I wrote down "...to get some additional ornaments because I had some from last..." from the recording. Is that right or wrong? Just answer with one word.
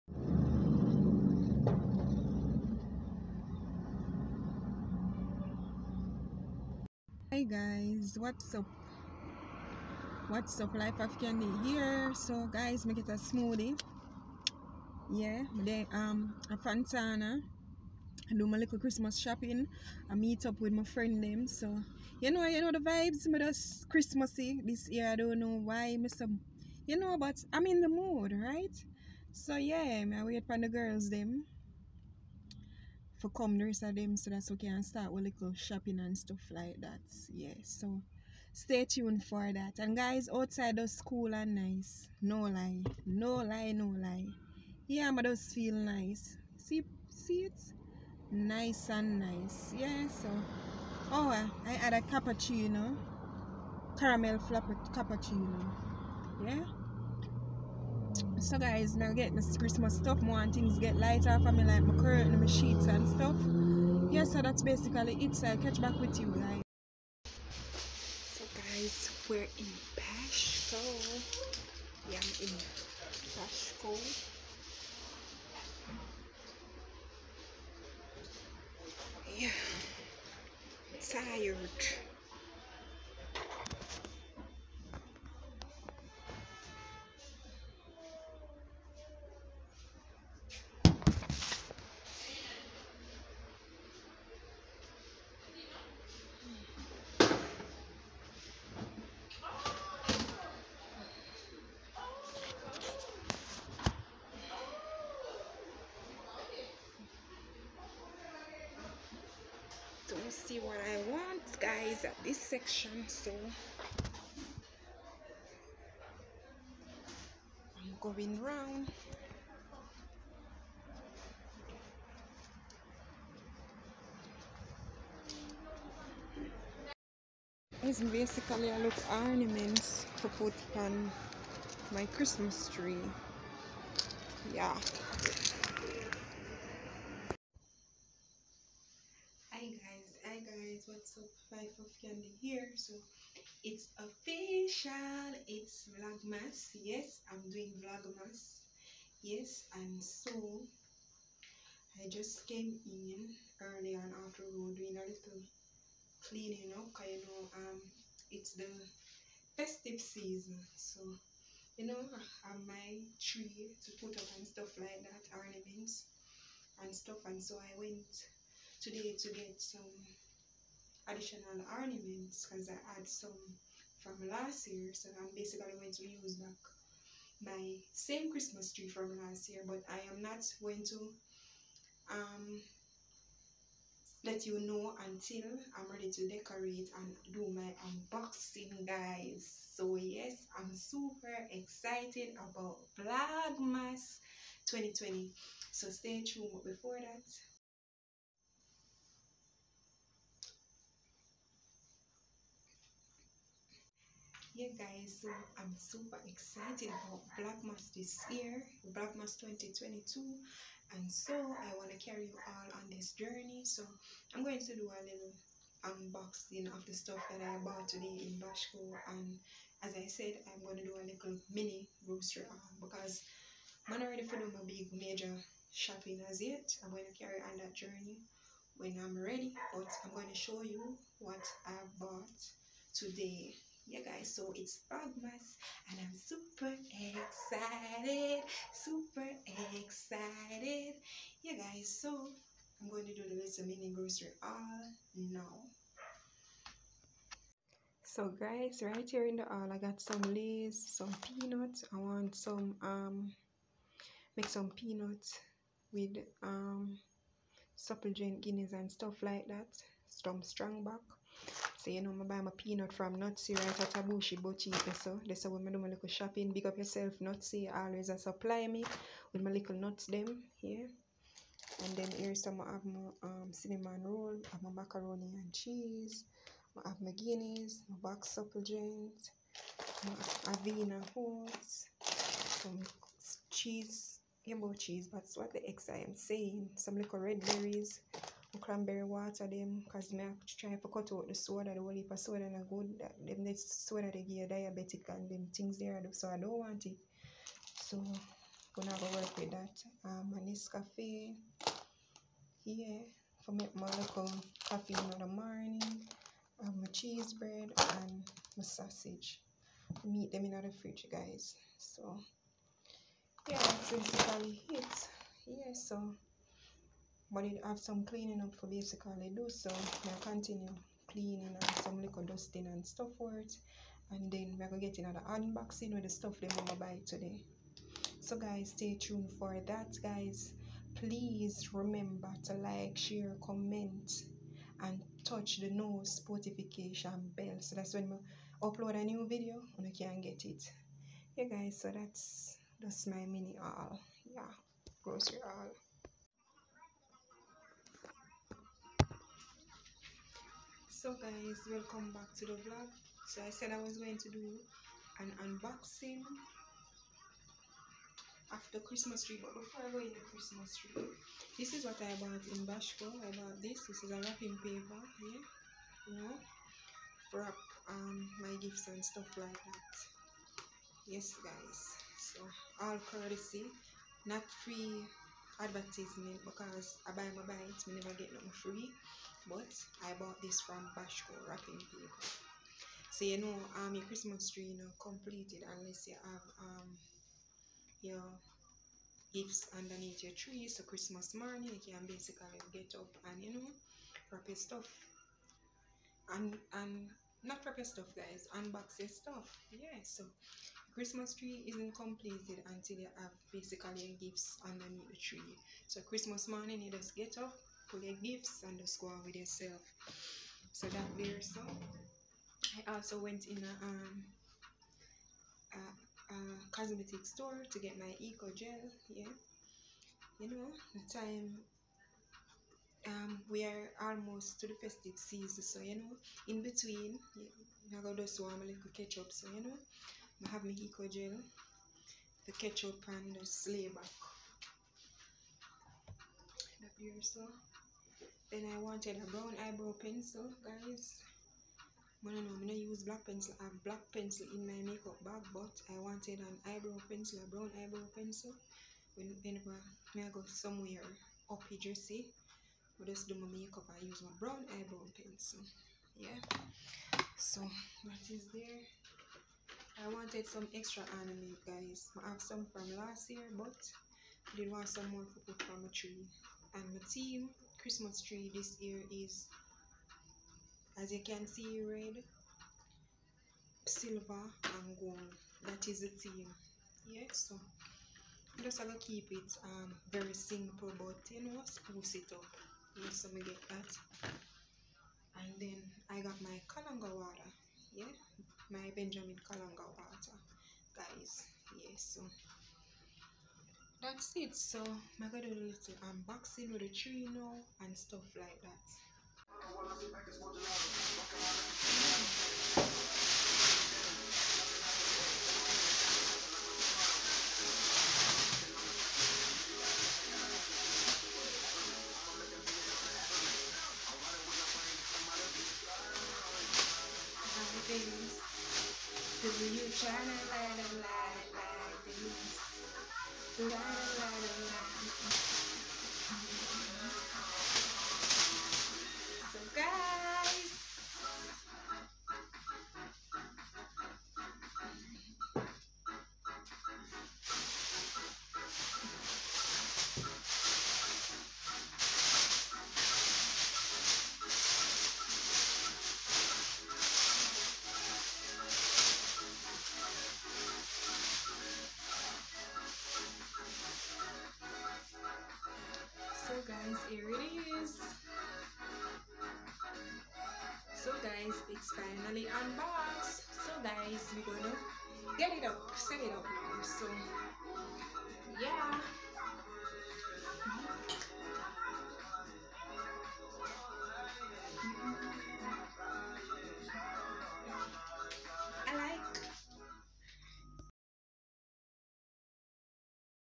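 right.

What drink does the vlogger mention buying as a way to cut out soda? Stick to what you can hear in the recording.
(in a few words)
cranberry water.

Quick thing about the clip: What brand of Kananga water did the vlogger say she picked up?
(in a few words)
Benjamin.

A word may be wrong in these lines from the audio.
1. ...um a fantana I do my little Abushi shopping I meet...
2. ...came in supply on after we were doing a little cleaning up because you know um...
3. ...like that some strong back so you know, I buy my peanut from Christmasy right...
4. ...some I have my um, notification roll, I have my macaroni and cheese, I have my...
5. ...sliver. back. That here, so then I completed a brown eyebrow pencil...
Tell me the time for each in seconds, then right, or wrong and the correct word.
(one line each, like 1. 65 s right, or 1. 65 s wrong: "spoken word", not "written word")
1. 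15 s wrong: "Christmas", not "Abushi"
2. 152 s wrong: "early", not "supply"
3. 259 s wrong: "Nutsy", not "Christmasy"
4. 272 s wrong: "cinnamon", not "notification"
5. 433 s wrong: "wanted", not "completed".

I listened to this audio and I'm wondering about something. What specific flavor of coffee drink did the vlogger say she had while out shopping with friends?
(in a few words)
Caramel flapper cappuccino.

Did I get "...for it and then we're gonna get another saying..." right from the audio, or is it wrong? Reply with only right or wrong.
wrong.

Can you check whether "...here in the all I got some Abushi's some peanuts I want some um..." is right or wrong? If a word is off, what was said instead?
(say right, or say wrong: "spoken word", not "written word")
wrong: "Lay", not "Abushi".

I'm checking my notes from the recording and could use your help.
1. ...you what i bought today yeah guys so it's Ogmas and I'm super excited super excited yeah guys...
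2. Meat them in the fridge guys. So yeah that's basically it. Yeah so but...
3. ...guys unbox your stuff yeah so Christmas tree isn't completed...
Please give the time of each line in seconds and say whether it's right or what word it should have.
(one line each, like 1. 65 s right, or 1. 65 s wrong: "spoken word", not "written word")
1. 230 s right
2. 310 s right
3. 398 s right.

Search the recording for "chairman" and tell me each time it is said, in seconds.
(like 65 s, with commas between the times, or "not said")
not said.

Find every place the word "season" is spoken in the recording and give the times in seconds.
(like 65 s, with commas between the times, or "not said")
159 s, 425 s.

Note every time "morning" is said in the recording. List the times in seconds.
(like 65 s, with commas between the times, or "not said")
305 s, 391 s, 406 s.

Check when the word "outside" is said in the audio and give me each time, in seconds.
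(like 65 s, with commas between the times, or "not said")
40 s.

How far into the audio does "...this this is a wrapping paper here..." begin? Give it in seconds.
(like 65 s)
363 s.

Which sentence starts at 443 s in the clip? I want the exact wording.
I have black pencil in my makeup bag, but I wanted an eyebrow pencil, a brown eyebrow pencil.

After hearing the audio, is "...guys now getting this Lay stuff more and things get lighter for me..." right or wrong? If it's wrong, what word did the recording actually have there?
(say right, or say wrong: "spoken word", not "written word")
wrong: "Christmas", not "Lay".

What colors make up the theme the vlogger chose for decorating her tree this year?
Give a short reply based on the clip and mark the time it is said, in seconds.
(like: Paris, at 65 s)
red, silver, and gold, at 471 s.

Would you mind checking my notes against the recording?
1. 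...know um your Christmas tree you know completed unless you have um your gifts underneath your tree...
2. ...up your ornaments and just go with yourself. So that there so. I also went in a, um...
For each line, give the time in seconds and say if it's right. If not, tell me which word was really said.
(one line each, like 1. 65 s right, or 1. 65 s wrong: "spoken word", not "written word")
1. 383 s right
2. 407 s wrong: "gifts", not "ornaments".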